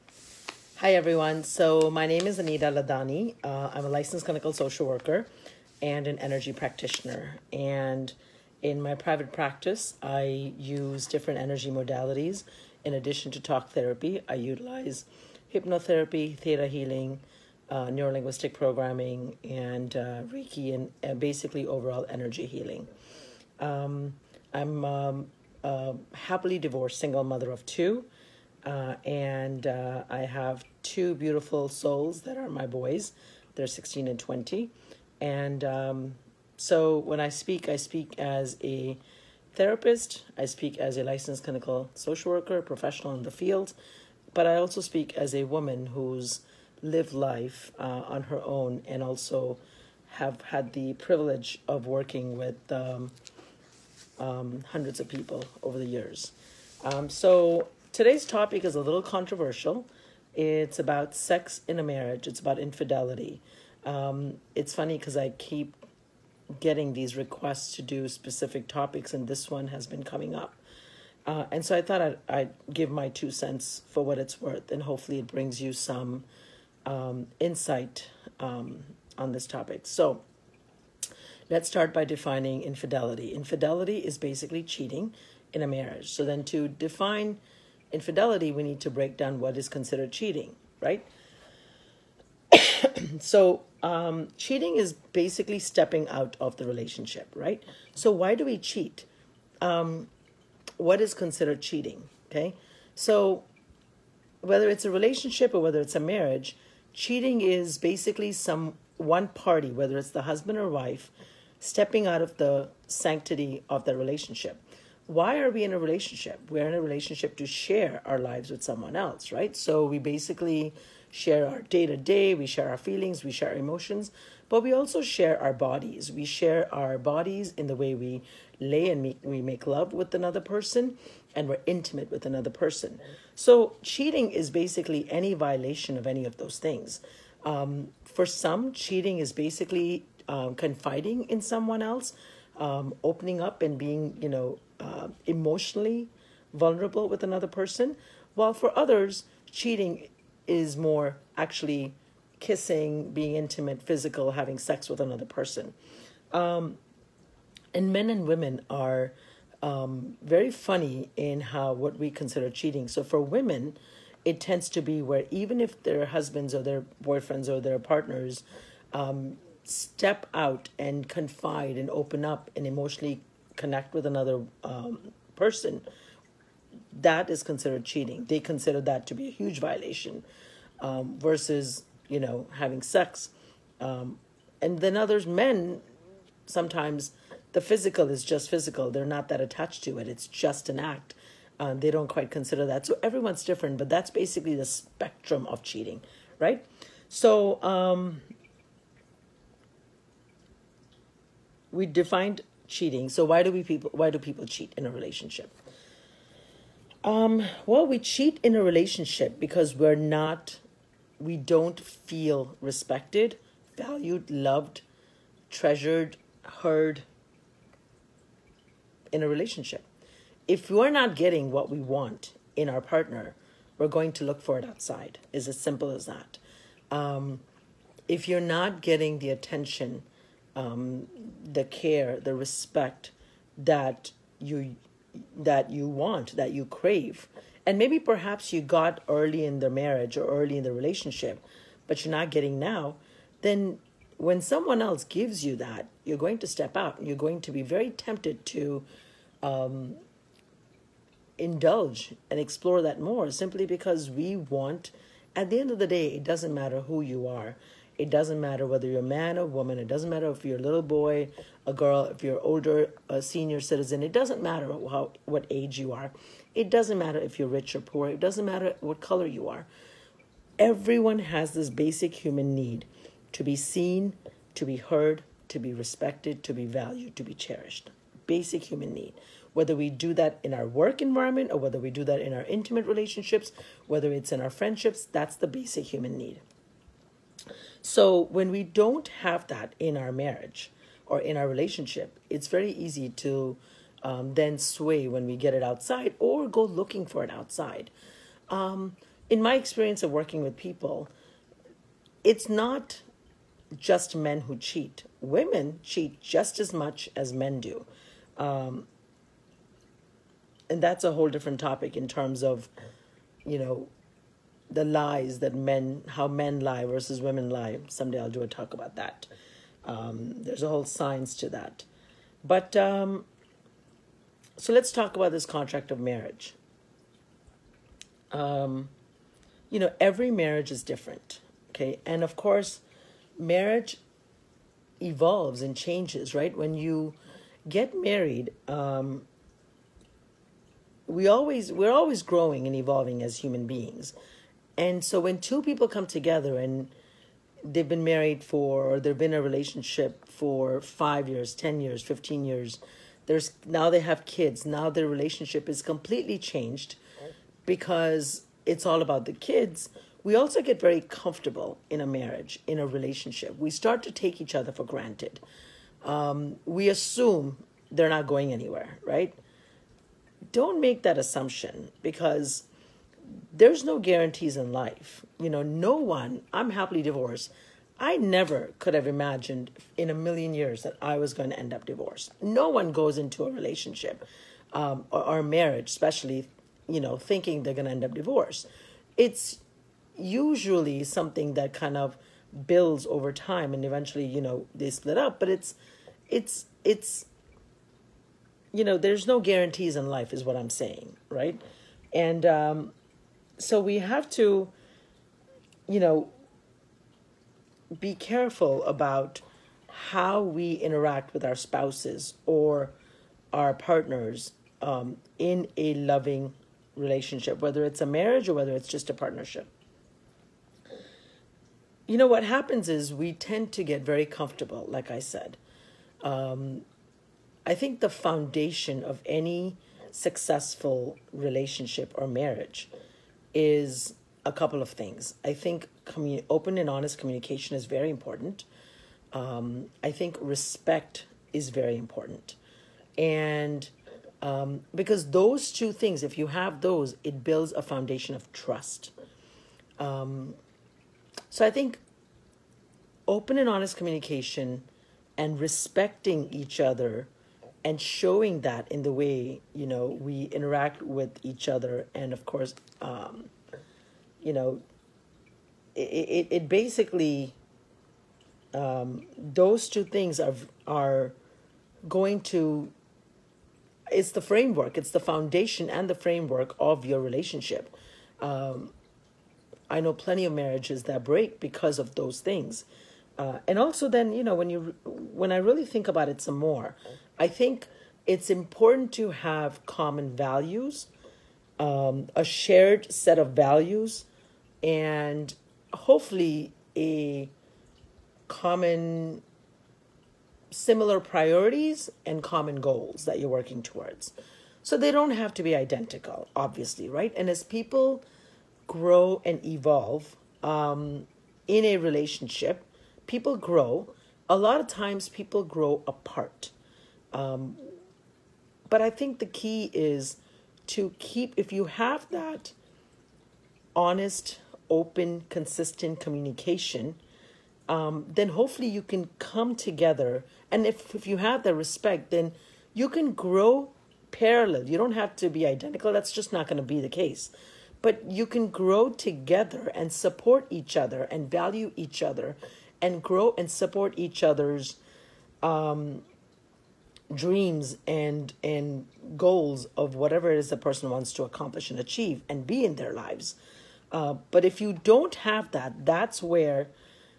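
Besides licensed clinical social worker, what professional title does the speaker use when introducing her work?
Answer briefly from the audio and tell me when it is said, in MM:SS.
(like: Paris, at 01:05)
energy practitioner, at 00:06.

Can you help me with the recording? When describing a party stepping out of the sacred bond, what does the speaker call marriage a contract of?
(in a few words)
sanctity.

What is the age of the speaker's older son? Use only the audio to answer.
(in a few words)
20.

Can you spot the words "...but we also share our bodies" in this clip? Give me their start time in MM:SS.
02:04.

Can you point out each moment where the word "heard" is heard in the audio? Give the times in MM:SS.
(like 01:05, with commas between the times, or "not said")
03:36, 04:34.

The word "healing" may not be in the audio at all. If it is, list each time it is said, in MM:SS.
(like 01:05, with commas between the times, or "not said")
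00:16, 00:22.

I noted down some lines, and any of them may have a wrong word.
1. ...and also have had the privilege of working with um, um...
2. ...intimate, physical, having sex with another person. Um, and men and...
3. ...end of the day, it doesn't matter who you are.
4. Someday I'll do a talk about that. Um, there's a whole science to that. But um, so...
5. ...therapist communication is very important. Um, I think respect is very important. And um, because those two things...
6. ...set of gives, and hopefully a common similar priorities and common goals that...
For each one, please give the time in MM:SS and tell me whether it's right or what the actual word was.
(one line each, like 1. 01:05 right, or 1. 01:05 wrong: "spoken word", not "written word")
1. 00:48 right
2. 02:33 right
3. 04:15 right
4. 05:17 right
5. 07:16 wrong: "honest", not "therapist"
6. 08:13 wrong: "values", not "gives".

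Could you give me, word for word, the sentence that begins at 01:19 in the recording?
So let's start by defining infidelity.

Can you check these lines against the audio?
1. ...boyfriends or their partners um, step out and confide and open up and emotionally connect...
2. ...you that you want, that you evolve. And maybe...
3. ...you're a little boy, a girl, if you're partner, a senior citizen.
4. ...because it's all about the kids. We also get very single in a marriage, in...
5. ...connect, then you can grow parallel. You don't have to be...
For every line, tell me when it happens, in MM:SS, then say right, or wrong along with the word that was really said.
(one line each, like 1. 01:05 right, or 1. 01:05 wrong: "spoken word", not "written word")
1. 02:47 right
2. 03:54 wrong: "crave", not "evolve"
3. 04:20 wrong: "older", not "partner"
4. 05:57 wrong: "comfortable", not "single"
5. 08:51 wrong: "respect", not "connect".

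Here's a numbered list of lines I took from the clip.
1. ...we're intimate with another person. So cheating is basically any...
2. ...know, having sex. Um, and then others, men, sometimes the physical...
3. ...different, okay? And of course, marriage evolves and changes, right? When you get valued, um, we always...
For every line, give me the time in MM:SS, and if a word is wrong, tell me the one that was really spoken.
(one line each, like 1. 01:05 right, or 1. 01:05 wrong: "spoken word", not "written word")
1. 02:11 right
2. 03:02 right
3. 05:30 wrong: "married", not "valued".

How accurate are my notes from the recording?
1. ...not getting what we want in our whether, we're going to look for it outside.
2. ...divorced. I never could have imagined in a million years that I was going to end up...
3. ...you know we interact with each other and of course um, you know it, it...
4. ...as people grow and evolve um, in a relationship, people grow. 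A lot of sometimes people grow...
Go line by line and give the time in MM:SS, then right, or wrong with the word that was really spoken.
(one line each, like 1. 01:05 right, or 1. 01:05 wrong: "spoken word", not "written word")
1. 03:40 wrong: "partner", not "whether"
2. 06:17 right
3. 07:39 right
4. 08:27 wrong: "times", not "sometimes".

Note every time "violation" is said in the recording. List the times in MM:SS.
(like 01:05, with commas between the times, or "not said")
02:15, 02:59.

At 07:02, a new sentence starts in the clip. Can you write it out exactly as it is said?
You know, what happens is we tend to get very comfortable, like I said.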